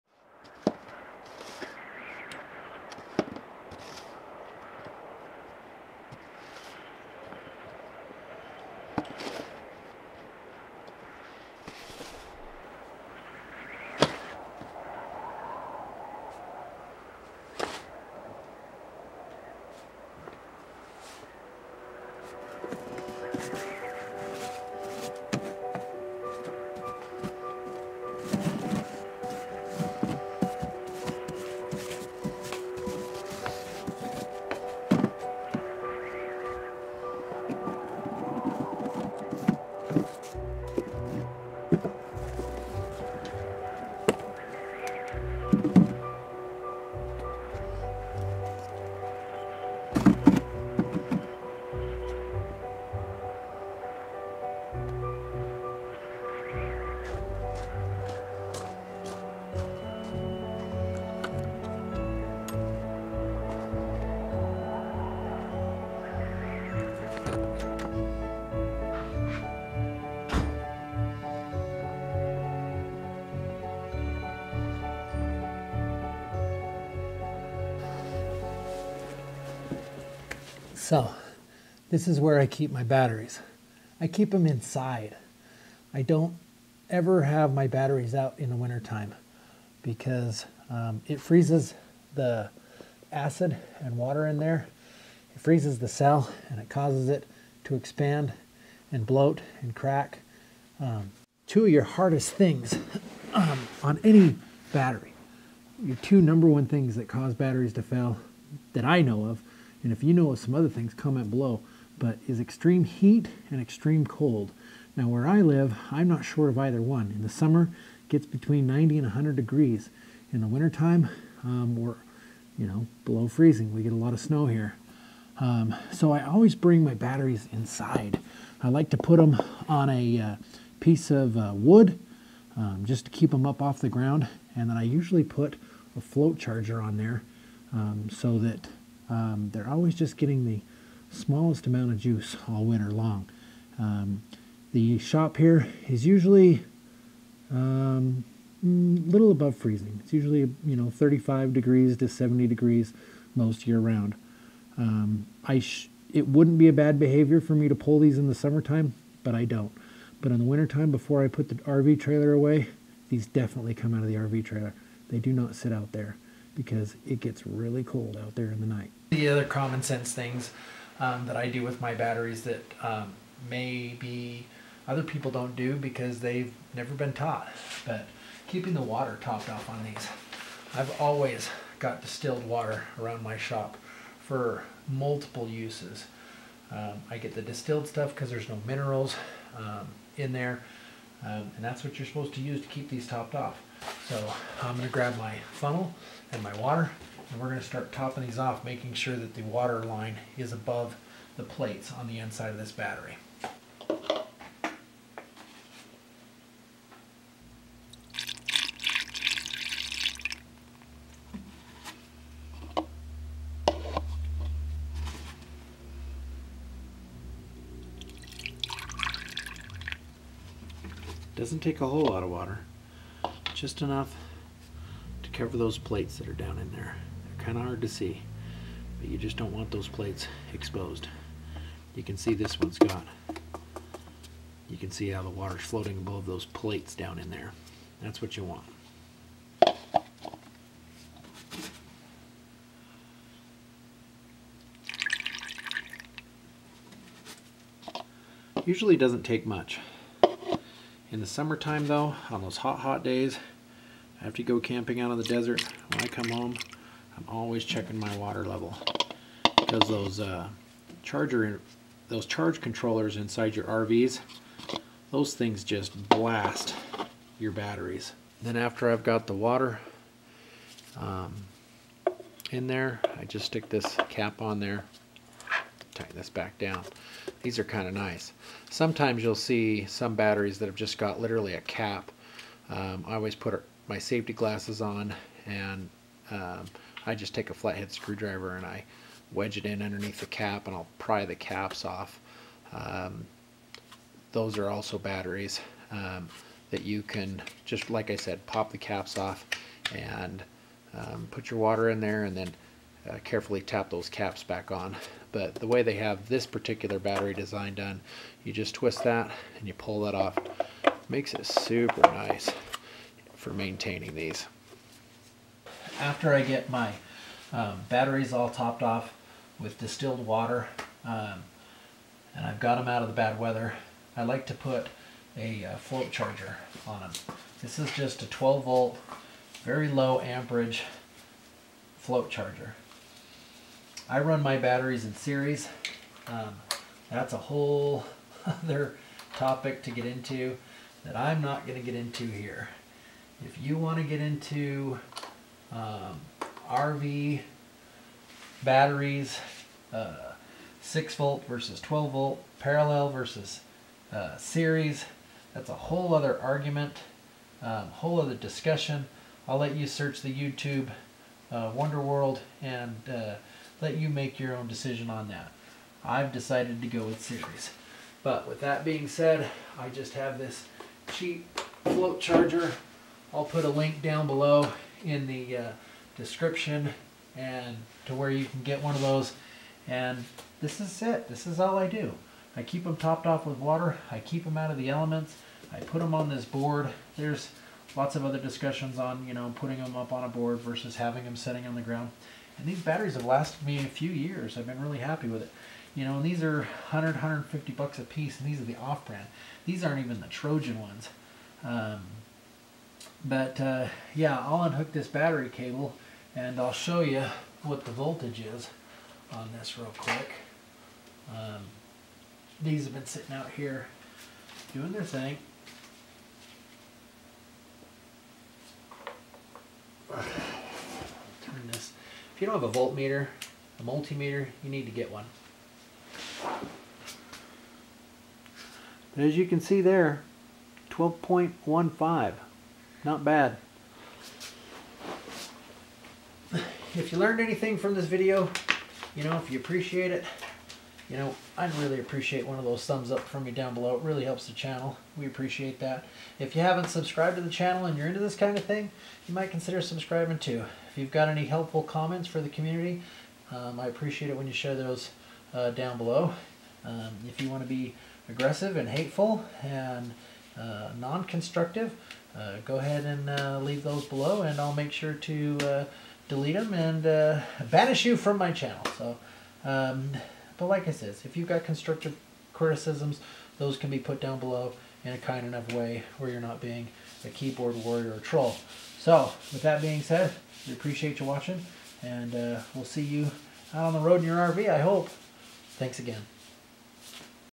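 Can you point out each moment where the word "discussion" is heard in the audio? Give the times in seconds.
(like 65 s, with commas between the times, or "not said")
358 s, 388 s.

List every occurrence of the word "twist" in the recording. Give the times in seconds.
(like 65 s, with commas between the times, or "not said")
308 s.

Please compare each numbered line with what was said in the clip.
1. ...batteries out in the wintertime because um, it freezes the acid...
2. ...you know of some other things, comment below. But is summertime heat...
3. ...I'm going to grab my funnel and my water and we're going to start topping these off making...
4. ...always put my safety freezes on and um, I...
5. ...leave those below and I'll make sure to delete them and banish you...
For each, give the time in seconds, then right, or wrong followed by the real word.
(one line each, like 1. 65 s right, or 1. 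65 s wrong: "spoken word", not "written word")
1. 87 s right
2. 110 s wrong: "extreme", not "summertime"
3. 194 s right
4. 283 s wrong: "glasses", not "freezes"
5. 463 s right.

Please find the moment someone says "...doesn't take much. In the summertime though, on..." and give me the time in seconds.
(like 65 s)
248 s.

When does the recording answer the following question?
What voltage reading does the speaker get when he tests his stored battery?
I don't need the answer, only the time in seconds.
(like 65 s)
430 s.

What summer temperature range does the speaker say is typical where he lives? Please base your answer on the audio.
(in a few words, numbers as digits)
90 to 100 degrees.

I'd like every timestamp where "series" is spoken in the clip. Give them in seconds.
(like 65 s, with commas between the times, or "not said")
335 s, 354 s, 367 s.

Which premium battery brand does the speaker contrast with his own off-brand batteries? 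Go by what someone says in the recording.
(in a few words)
Trojan.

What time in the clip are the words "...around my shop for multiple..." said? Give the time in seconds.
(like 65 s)
182 s.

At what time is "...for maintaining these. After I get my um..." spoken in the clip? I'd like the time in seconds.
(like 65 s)
313 s.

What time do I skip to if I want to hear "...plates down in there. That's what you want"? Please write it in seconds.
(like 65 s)
236 s.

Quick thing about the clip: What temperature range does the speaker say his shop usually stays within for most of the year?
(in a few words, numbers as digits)
35 to 70 degrees.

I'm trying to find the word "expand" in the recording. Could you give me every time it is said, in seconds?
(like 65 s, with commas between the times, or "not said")
97 s.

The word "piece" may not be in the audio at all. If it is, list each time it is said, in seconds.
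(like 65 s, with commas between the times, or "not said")
130 s, 398 s.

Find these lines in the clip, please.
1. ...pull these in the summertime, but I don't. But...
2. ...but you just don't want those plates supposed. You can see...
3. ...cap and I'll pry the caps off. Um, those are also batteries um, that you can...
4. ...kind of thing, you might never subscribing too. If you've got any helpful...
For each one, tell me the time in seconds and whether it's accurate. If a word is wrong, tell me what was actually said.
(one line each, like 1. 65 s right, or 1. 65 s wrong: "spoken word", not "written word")
1. 157 s right
2. 228 s wrong: "exposed", not "supposed"
3. 290 s right
4. 448 s wrong: "consider", not "never".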